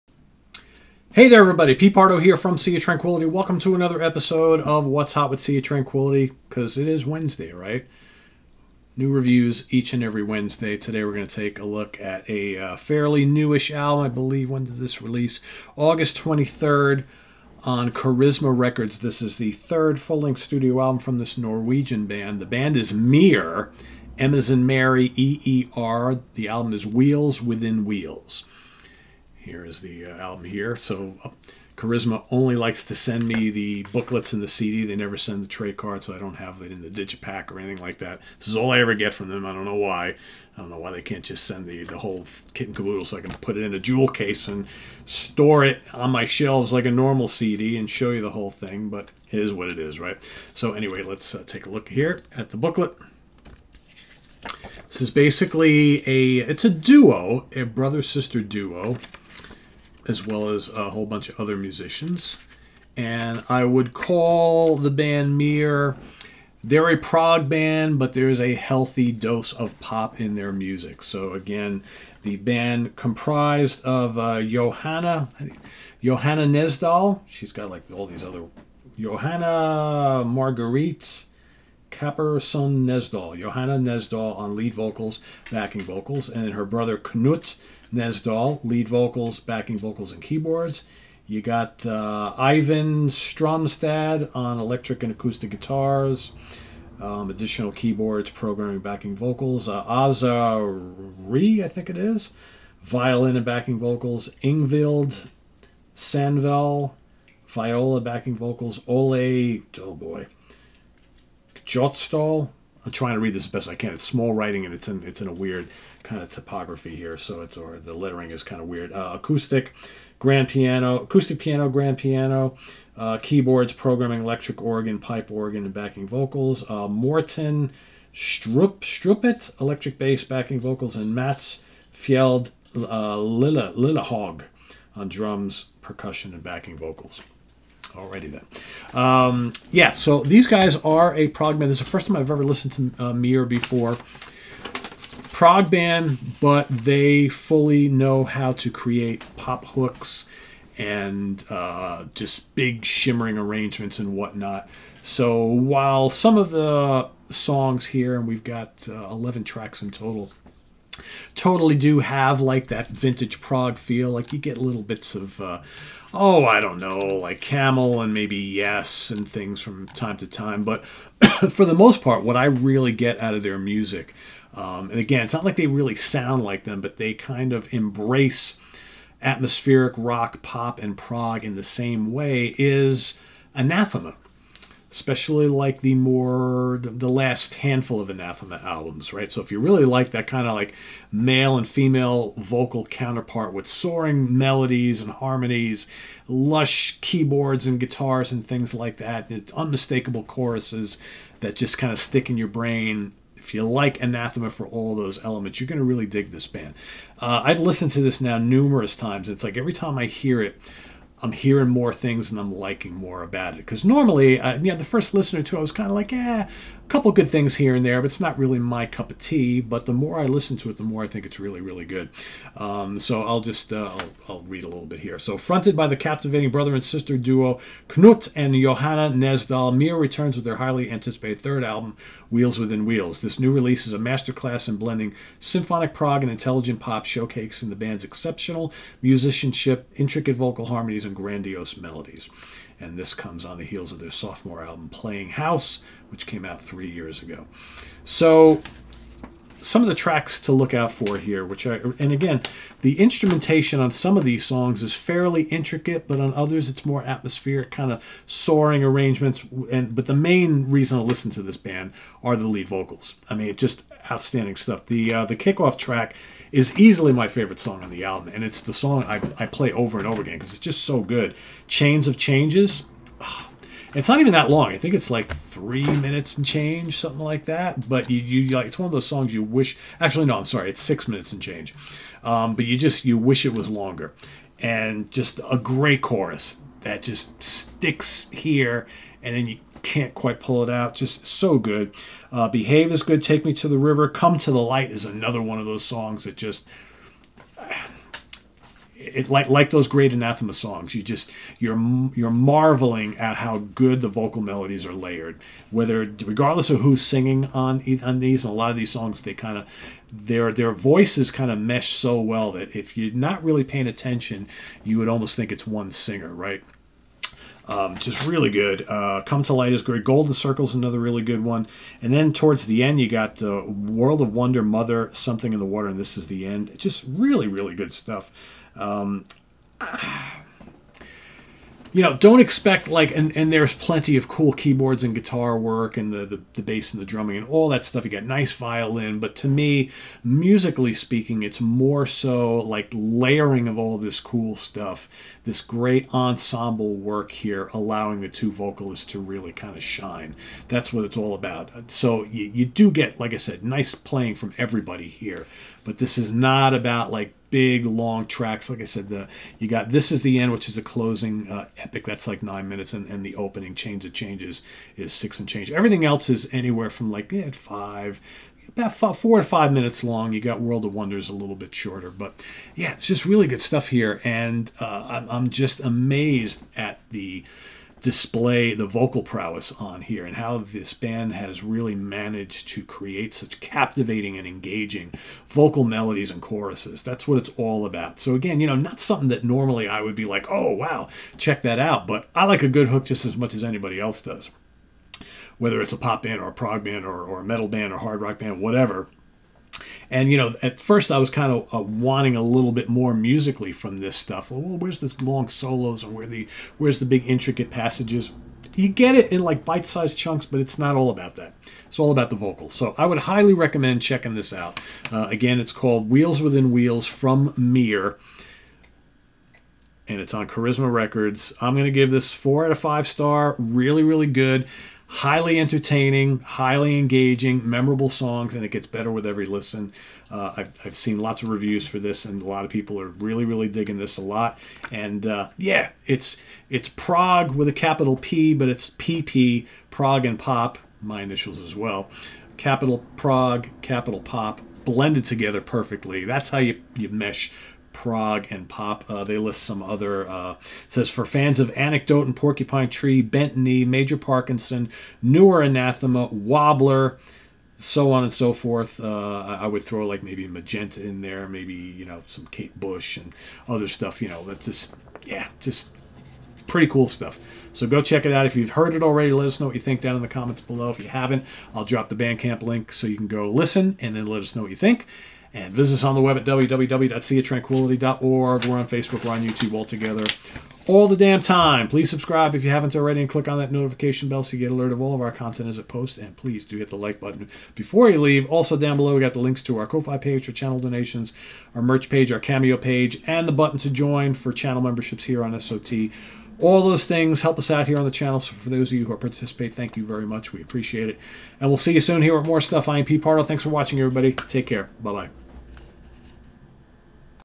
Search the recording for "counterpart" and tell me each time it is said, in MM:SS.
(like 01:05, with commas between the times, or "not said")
03:12.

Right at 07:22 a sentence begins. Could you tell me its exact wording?
Capital Prog, capital Pop, blended together perfectly.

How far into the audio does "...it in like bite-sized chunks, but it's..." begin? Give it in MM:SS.
06:49.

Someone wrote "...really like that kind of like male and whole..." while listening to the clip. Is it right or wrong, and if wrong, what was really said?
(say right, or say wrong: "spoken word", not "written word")
wrong: "female", not "whole".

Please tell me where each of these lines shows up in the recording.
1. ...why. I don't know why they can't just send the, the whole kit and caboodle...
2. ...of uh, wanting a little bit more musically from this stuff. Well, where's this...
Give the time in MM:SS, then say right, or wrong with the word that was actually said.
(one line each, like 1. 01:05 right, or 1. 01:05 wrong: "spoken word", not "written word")
1. 00:39 right
2. 06:41 right.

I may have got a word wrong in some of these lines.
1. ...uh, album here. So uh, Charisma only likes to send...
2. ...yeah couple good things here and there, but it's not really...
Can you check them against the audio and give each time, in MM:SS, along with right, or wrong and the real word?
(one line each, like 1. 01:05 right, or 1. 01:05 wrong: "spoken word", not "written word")
1. 00:30 right
2. 03:36 right.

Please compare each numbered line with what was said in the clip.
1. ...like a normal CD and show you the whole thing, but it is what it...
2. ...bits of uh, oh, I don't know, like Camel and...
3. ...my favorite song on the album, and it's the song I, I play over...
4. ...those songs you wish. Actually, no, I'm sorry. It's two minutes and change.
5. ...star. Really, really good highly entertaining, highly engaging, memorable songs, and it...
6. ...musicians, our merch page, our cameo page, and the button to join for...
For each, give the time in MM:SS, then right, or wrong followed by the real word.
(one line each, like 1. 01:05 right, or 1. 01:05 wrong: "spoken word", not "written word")
1. 00:46 right
2. 02:44 right
3. 04:27 right
4. 04:38 wrong: "six", not "two"
5. 07:03 right
6. 08:10 wrong: "donations", not "musicians".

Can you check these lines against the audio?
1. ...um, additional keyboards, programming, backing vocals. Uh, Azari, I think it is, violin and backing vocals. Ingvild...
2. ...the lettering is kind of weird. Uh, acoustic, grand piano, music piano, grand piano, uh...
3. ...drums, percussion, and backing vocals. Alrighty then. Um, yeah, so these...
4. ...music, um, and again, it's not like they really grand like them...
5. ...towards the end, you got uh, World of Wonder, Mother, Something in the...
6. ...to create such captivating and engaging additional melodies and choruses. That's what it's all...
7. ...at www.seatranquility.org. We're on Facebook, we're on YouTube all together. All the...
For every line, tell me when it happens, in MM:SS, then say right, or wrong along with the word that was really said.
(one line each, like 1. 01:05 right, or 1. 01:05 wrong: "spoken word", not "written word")
1. 01:36 right
2. 01:57 wrong: "acoustic", not "music"
3. 02:15 right
4. 02:53 wrong: "sound", not "grand"
5. 05:22 right
6. 06:22 wrong: "vocal", not "additional"
7. 07:56 right.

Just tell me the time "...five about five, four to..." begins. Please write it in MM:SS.
06:07.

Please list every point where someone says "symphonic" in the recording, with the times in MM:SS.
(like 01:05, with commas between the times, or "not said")
03:55.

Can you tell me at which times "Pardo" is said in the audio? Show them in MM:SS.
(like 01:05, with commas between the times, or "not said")
00:01, 08:23.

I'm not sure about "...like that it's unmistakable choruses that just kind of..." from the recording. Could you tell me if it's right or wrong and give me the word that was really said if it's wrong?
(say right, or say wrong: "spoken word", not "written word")
right.